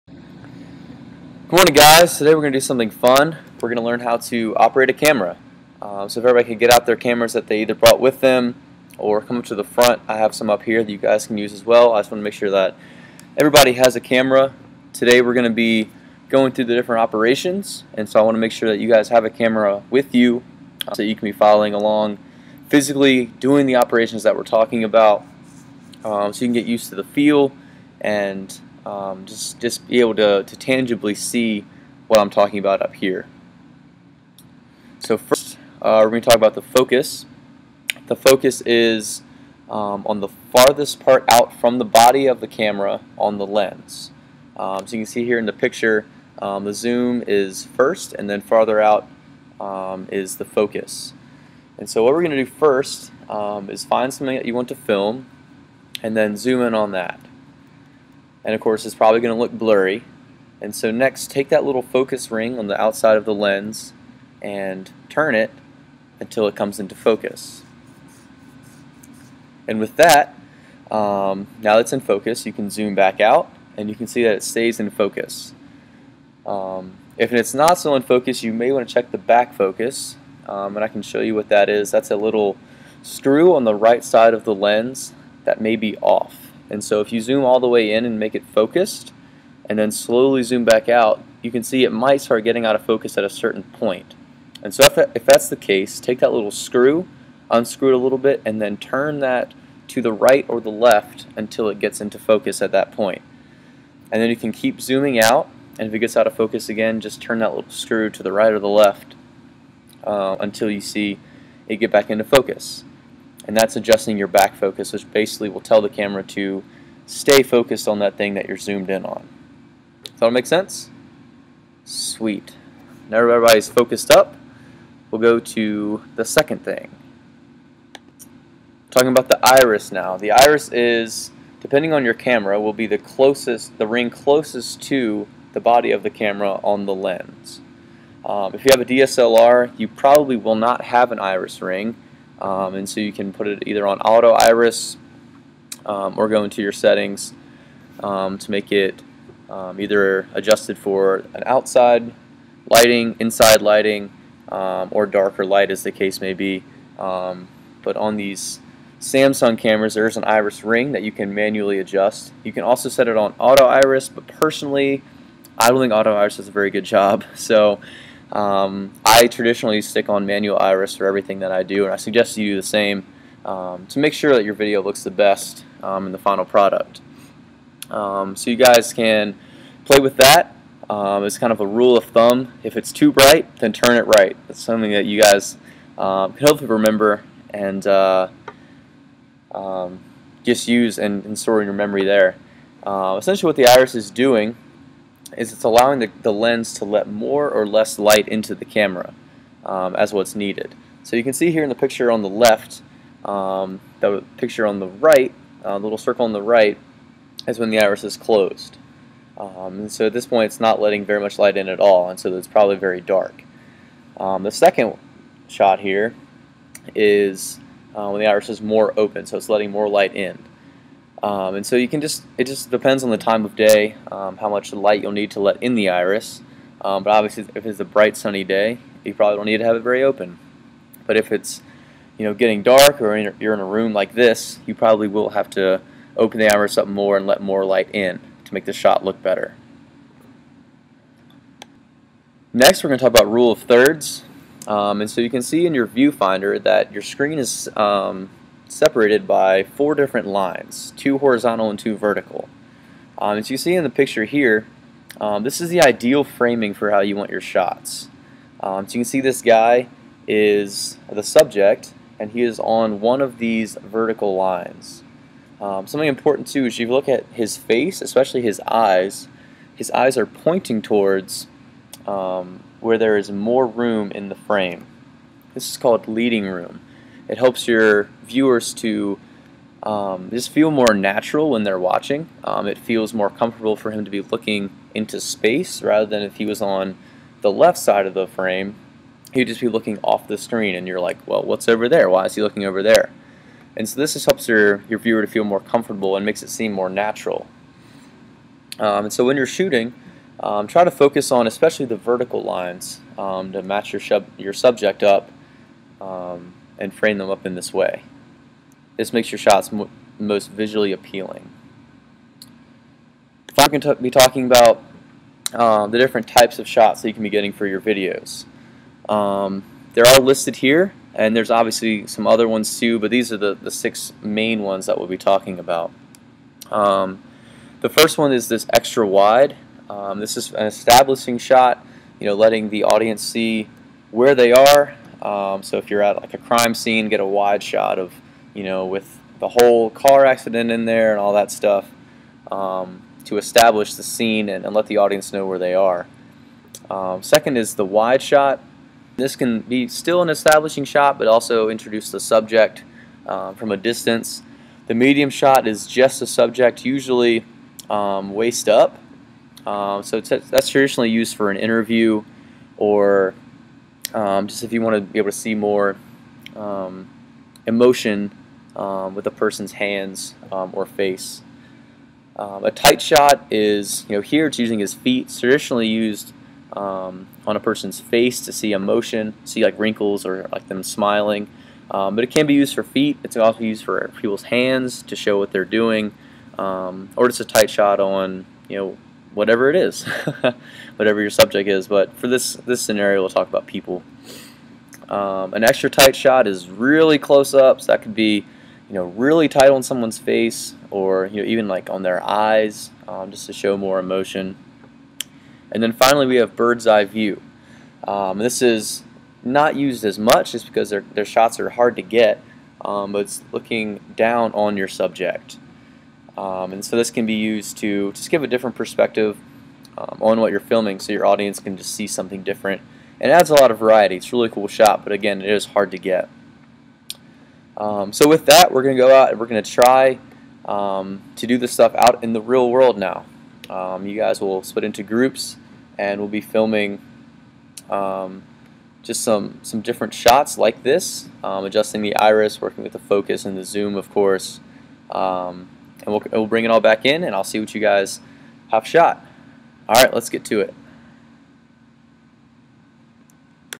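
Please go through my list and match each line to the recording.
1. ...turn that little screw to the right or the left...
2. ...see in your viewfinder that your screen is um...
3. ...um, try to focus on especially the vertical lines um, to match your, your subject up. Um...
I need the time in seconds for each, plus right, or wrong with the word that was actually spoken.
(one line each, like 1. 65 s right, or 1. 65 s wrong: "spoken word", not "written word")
1. 107 s right
2. 245 s right
3. 300 s right.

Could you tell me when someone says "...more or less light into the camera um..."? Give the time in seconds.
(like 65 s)
197 s.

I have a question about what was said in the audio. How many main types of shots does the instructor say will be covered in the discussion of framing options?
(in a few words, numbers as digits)
6.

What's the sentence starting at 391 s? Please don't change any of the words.
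But for this this scenario, we'll talk about people.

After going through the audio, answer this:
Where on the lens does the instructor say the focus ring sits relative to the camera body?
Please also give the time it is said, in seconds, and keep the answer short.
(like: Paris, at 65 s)
farthest part out, at 40 s.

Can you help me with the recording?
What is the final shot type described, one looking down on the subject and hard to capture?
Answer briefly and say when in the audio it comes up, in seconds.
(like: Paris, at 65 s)
bird's eye view, at 406 s.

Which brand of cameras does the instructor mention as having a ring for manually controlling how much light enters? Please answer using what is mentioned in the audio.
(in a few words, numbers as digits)
Samsung.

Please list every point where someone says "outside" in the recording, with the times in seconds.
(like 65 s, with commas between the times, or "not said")
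62 s, 151 s.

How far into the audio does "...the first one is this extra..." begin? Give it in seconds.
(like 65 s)
327 s.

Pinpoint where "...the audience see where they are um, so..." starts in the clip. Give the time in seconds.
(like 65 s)
332 s.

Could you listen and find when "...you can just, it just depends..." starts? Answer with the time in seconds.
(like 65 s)
221 s.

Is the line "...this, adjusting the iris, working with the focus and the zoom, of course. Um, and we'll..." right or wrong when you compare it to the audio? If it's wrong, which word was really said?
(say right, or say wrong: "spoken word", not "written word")
right.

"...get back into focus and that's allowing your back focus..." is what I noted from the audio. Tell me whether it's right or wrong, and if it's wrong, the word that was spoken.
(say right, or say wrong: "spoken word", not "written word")
wrong: "adjusting", not "allowing".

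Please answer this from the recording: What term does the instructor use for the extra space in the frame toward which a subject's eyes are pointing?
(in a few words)
leading room.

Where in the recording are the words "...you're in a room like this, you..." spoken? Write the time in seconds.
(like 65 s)
233 s.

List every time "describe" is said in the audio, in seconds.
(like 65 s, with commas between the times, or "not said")
not said.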